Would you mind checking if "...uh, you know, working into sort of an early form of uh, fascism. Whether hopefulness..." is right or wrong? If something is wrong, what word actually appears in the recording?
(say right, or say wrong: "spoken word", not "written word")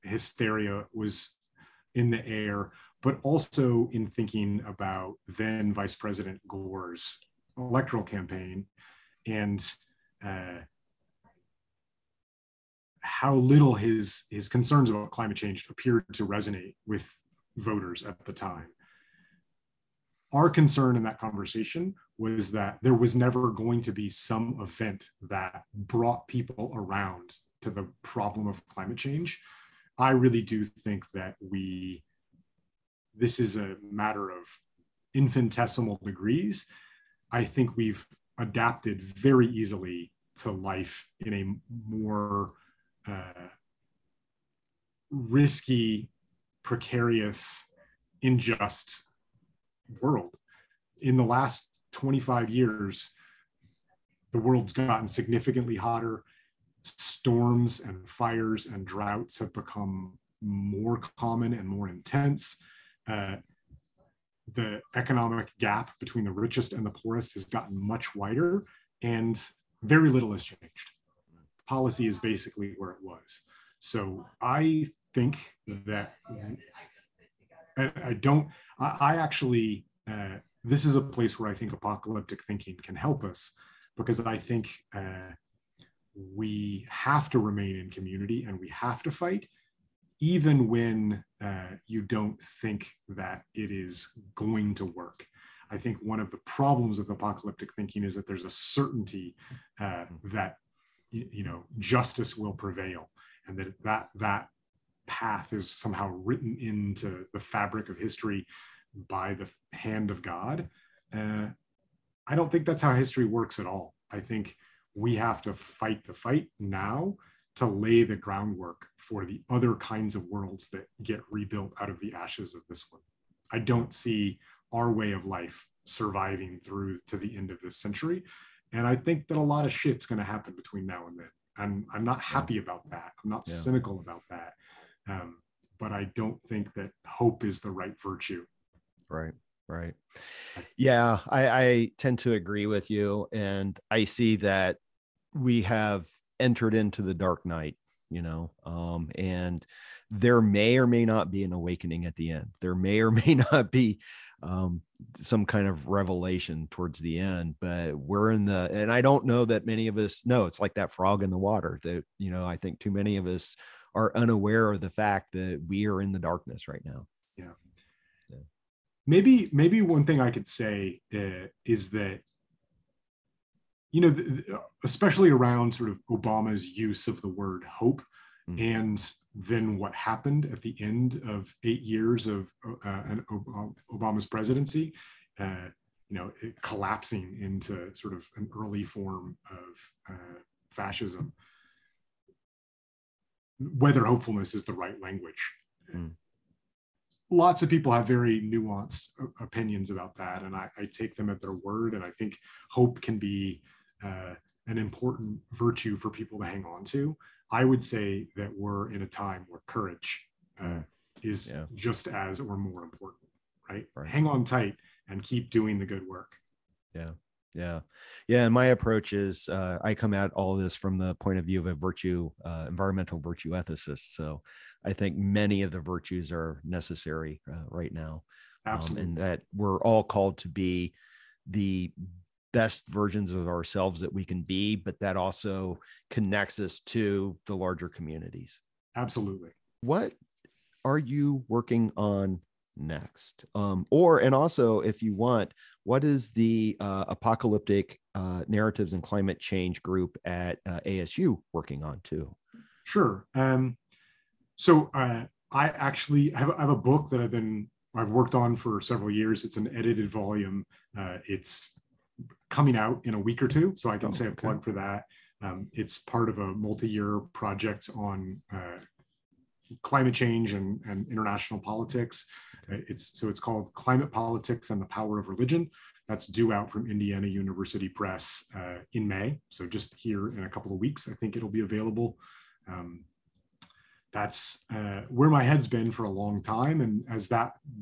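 wrong: "collapsing", not "working".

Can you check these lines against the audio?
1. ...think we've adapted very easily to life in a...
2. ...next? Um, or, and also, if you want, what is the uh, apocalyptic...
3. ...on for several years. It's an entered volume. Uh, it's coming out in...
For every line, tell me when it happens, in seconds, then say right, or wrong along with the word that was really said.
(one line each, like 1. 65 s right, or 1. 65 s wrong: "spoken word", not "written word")
1. 37 s right
2. 242 s right
3. 258 s wrong: "edited", not "entered".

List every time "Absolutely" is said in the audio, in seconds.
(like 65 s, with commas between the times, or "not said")
228 s, 238 s.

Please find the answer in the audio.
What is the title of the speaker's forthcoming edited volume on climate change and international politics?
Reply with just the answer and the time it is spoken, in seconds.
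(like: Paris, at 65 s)
Climate Politics and the Power of Religion, at 273 s.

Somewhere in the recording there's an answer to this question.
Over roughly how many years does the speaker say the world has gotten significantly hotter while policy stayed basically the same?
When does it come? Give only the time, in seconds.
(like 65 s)
51 s.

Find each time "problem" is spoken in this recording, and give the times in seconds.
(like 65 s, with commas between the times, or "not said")
28 s, 96 s.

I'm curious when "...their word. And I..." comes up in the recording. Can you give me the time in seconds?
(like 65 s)
201 s.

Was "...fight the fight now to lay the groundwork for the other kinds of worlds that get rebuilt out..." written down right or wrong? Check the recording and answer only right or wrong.
right.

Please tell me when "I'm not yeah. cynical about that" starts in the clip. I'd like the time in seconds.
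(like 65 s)
133 s.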